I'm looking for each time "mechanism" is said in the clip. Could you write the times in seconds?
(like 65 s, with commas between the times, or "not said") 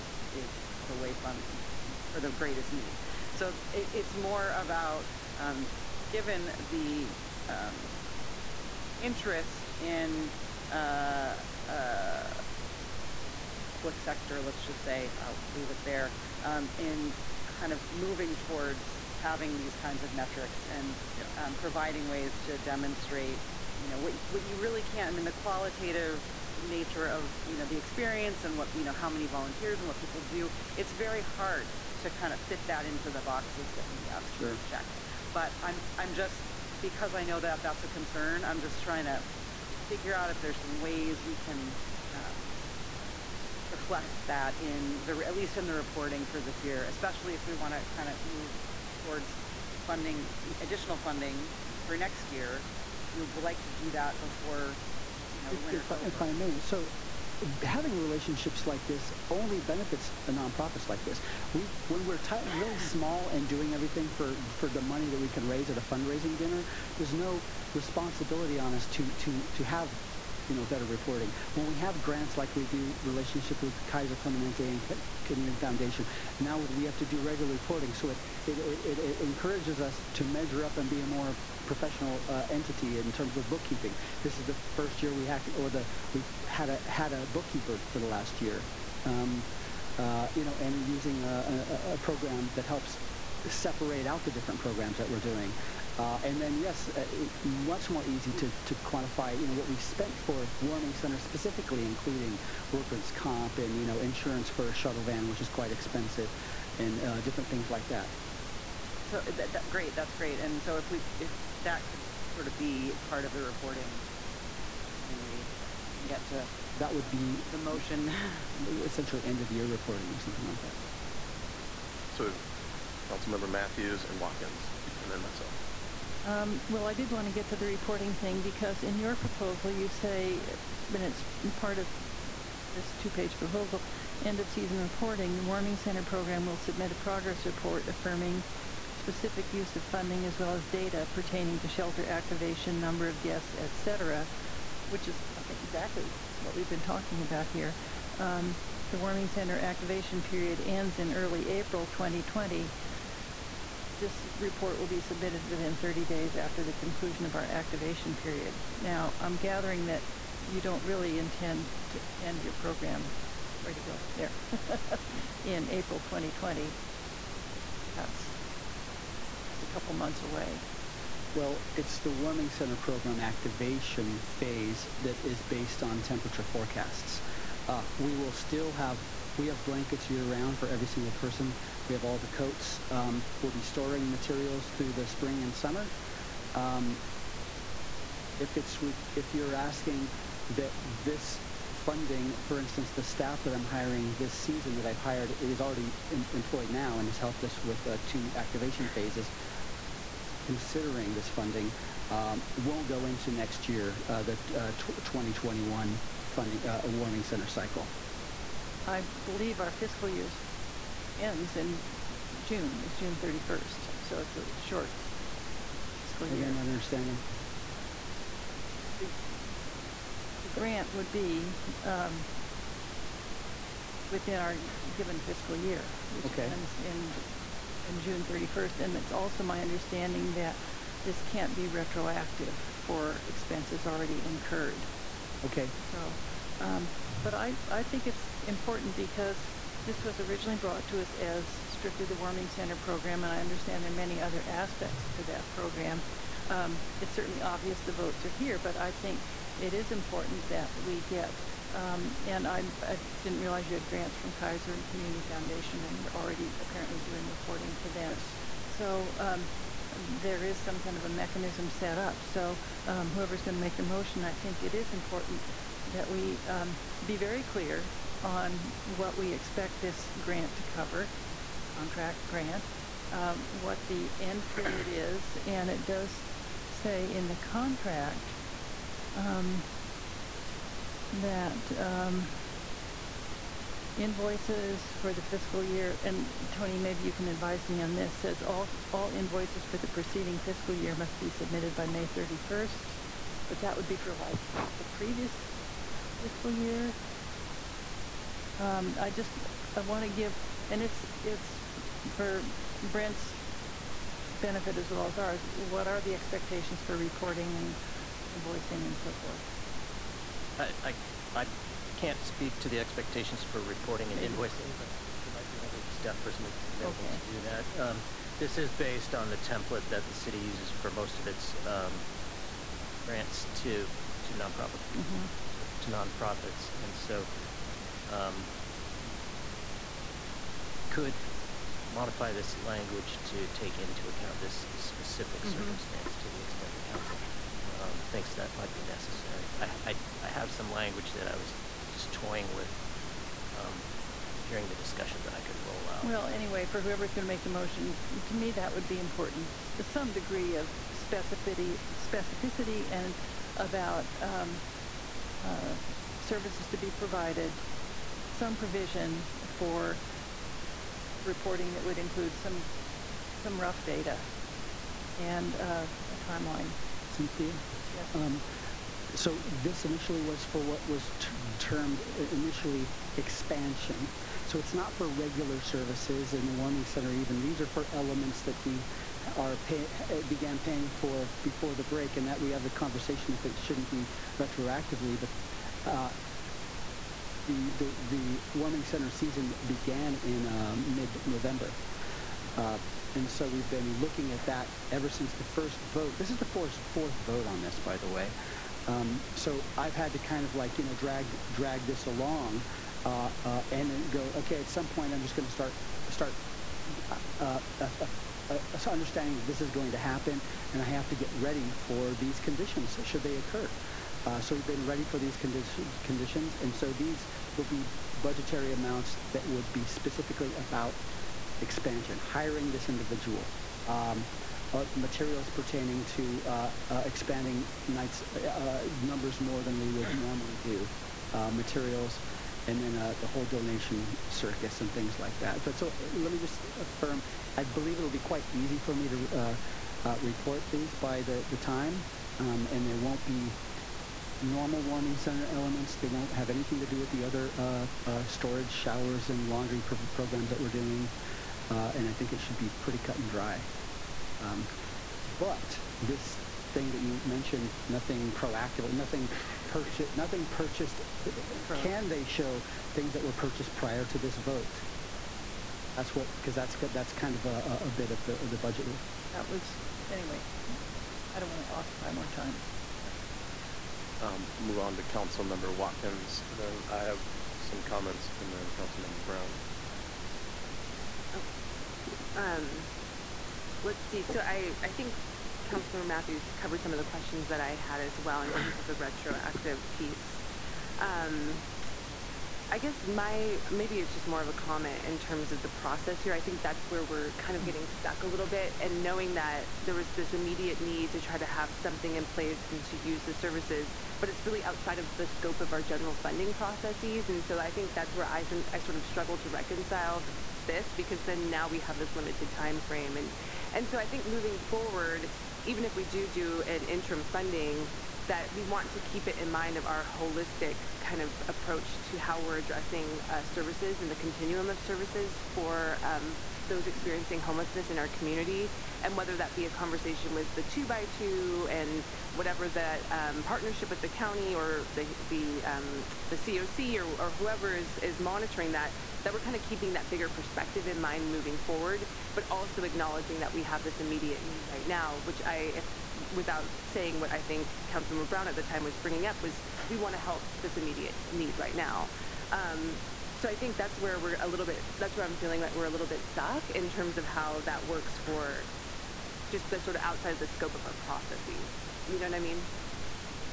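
261 s.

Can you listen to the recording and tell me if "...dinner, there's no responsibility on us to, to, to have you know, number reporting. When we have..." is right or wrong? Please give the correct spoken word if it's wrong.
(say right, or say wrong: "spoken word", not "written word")
wrong: "better", not "number".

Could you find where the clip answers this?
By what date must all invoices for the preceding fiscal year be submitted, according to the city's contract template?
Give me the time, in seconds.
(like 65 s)
291 s.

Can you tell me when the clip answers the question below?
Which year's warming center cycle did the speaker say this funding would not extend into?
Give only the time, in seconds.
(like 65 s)
204 s.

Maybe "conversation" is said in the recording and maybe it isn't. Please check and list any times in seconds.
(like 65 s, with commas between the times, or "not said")
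382 s, 529 s.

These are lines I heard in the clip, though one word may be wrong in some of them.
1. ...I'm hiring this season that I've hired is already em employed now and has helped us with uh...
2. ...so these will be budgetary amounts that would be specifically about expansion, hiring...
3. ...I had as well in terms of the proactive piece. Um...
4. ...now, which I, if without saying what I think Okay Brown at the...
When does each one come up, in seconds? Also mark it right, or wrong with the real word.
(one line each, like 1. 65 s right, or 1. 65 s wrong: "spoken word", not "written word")
1. 193 s right
2. 416 s right
3. 487 s wrong: "retroactive", not "proactive"
4. 544 s wrong: "Councilmember", not "Okay".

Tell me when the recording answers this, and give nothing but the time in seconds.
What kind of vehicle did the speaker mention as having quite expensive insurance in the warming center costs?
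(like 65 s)
104 s.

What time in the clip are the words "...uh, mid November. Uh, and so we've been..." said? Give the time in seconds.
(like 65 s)
390 s.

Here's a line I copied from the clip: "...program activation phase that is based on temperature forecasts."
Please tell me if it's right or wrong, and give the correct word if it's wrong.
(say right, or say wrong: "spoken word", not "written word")
right.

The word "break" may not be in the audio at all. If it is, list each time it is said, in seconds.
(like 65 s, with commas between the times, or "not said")
381 s.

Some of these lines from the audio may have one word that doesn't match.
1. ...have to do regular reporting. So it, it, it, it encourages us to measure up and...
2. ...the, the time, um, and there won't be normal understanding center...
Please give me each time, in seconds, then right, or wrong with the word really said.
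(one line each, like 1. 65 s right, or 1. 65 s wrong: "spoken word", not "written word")
1. 76 s right
2. 441 s wrong: "warming", not "understanding".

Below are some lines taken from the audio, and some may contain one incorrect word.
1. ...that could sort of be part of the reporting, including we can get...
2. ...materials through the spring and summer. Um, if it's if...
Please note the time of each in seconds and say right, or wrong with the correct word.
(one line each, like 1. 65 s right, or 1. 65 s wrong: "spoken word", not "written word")
1. 111 s wrong: "assuming", not "including"
2. 184 s right.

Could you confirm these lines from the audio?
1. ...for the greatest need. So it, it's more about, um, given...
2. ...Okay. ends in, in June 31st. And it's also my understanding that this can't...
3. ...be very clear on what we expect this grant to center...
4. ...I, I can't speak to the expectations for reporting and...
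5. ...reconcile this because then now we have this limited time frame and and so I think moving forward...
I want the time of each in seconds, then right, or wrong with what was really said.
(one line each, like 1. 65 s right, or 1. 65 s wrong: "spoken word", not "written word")
1. 2 s right
2. 226 s right
3. 267 s wrong: "cover", not "center"
4. 310 s right
5. 509 s right.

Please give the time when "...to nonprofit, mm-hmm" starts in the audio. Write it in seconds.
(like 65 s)
324 s.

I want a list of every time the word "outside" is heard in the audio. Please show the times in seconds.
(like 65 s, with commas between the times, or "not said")
504 s, 560 s.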